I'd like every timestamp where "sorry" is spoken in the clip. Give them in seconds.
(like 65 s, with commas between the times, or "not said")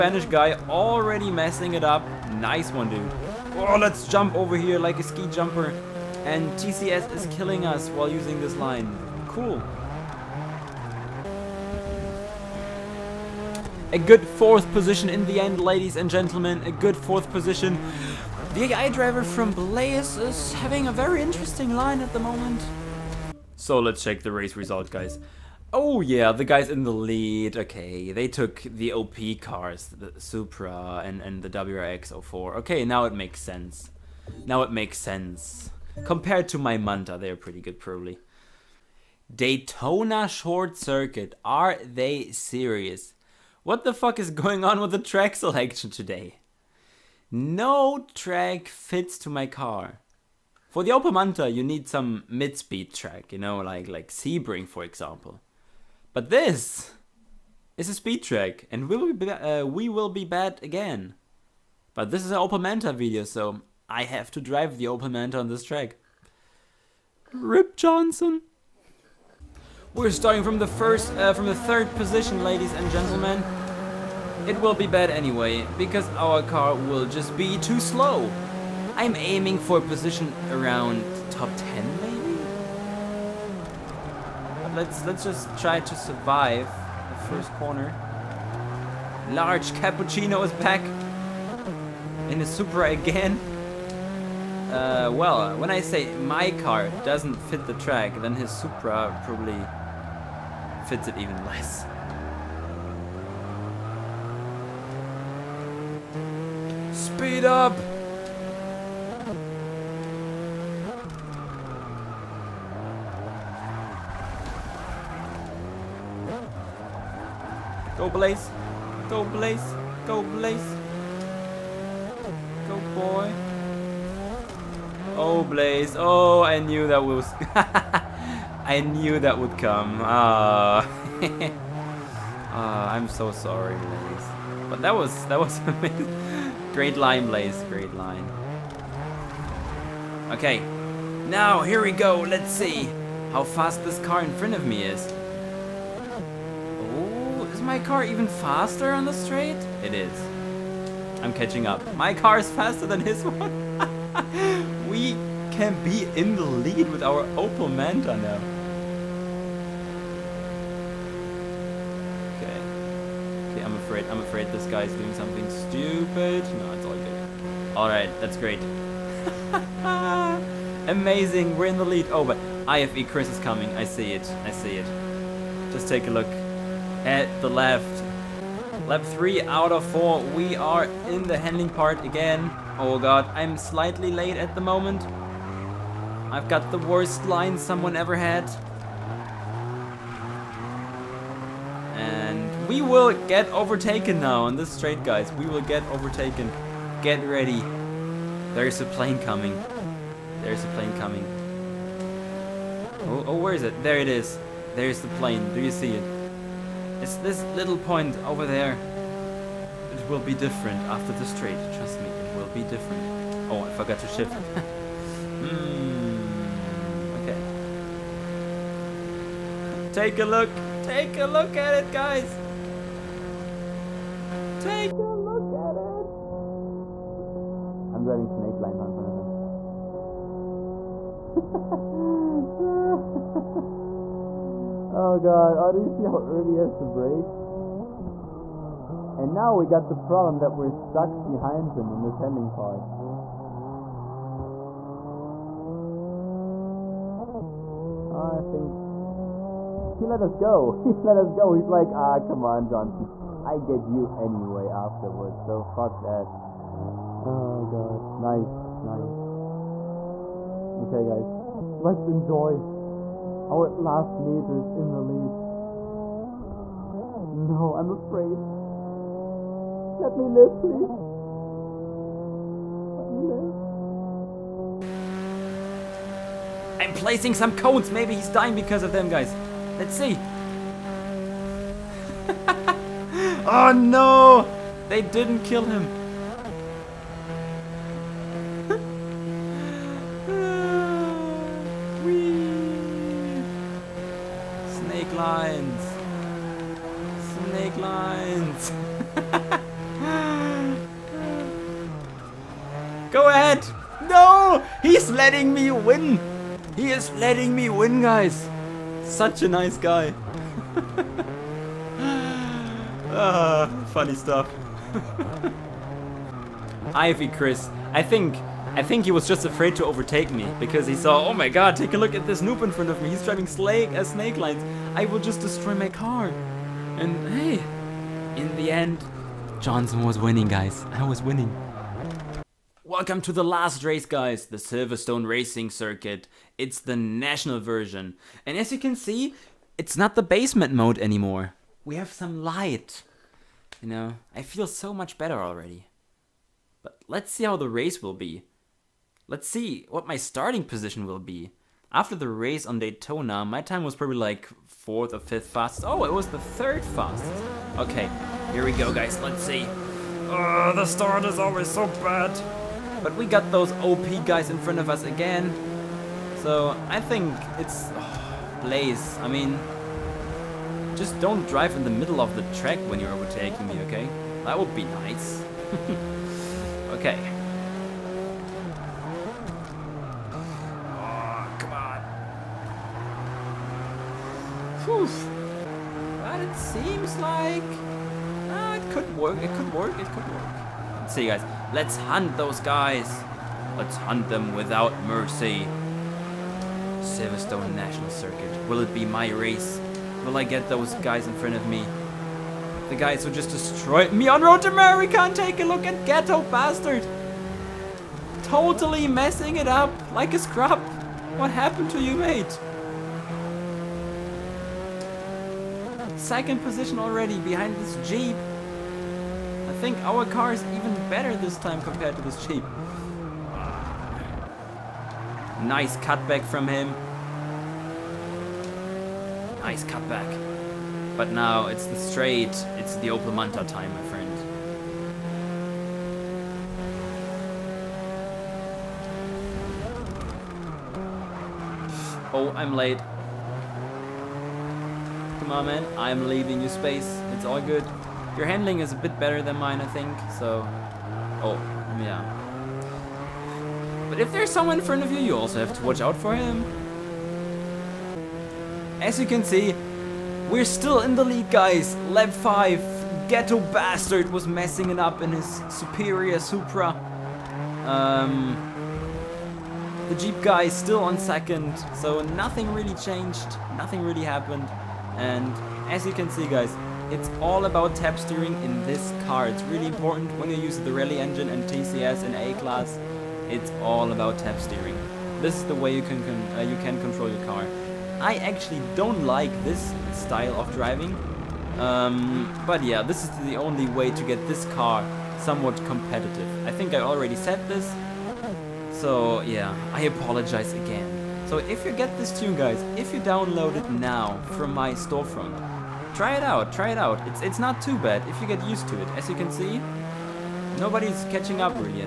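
133 s.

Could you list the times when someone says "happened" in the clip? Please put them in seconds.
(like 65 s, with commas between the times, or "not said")
411 s, 474 s.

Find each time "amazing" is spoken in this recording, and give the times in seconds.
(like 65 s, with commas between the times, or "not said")
135 s, 170 s.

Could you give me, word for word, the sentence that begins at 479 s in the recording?
It's really important when you use the rally engine and TCS and A-Class.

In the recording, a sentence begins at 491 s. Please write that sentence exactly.
Um, but yeah, this is the only way to get this car somewhat competitive.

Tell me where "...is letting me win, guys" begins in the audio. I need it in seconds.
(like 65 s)
306 s.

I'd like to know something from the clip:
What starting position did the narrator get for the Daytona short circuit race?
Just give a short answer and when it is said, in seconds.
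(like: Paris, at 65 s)
Third, at 71 s.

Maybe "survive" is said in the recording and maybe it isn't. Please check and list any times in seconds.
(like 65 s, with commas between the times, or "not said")
85 s.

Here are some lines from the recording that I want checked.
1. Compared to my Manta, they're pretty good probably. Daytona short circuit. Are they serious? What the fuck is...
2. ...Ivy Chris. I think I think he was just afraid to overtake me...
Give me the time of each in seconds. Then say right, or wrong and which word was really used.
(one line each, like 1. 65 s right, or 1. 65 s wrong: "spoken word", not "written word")
1. 36 s right
2. 316 s right.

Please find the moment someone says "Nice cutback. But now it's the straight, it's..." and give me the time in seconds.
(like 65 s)
429 s.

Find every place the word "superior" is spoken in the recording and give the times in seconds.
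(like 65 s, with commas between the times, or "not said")
465 s.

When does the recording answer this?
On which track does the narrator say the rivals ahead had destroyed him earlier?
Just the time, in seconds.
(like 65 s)
404 s.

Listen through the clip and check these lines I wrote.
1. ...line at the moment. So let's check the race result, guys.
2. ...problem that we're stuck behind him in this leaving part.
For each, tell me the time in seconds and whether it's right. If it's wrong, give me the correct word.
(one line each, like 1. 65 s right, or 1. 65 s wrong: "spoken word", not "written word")
1. 21 s right
2. 239 s wrong: "handling", not "leaving".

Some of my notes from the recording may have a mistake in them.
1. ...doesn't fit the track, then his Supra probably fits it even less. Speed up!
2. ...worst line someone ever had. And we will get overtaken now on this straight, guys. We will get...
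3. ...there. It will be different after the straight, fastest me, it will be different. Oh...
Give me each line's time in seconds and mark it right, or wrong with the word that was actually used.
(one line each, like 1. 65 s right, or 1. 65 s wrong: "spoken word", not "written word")
1. 97 s right
2. 186 s right
3. 208 s wrong: "trust", not "fastest".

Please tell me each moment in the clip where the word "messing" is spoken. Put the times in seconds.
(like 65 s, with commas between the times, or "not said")
1 s, 409 s, 464 s.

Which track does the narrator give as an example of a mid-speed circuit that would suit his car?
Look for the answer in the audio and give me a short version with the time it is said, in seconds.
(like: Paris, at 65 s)
Sebring, at 54 s.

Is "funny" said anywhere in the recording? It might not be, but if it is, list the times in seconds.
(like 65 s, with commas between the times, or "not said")
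313 s.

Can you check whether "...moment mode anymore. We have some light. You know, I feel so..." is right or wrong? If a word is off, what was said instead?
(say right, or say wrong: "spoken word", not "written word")
wrong: "basement", not "moment".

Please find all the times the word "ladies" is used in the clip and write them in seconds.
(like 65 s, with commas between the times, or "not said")
15 s, 72 s.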